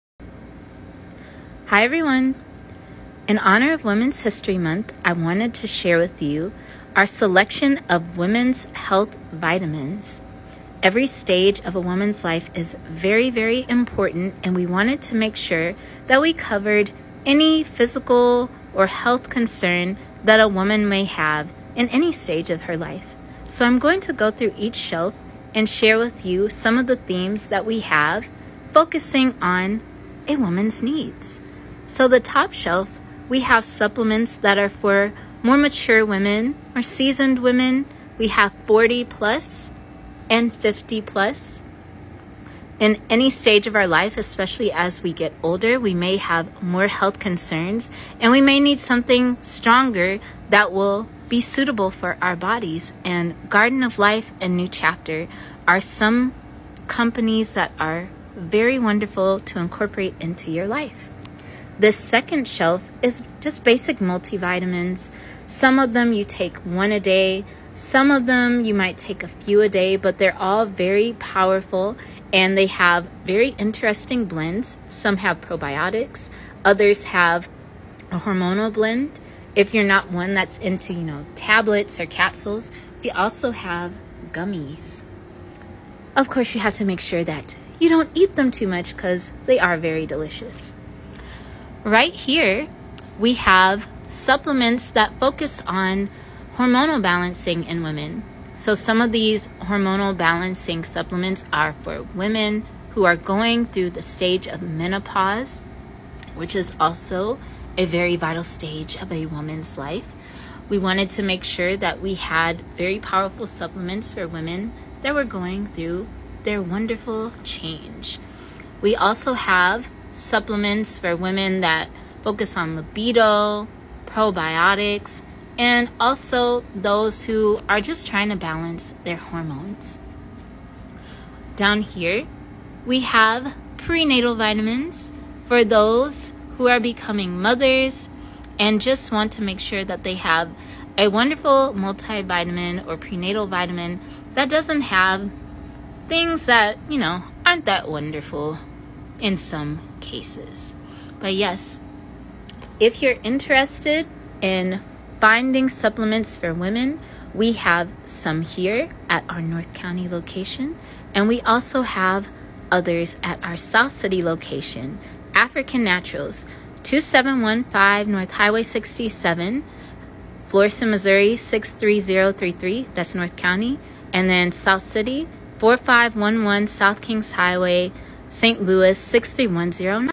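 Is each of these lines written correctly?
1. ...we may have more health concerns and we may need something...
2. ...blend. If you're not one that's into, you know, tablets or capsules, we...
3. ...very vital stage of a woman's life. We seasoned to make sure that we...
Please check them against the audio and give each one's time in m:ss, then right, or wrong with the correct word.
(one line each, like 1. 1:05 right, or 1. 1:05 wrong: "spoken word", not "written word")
1. 0:45 right
2. 1:18 right
3. 1:47 wrong: "wanted", not "seasoned".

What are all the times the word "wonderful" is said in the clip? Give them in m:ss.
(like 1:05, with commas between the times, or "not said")
0:58, 1:56, 2:21, 2:27.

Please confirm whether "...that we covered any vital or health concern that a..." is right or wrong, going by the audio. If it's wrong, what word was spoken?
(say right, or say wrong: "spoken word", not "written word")
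wrong: "physical", not "vital".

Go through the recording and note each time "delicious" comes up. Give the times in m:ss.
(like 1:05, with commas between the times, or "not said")
1:30.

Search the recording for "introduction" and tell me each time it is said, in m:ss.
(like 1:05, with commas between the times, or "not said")
not said.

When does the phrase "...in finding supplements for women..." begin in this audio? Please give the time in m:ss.
2:34.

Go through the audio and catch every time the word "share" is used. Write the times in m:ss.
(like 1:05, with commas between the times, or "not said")
0:05, 0:25.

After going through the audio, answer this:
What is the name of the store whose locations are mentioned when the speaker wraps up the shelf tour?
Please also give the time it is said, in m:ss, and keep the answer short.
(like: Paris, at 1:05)
African Naturals, at 2:45.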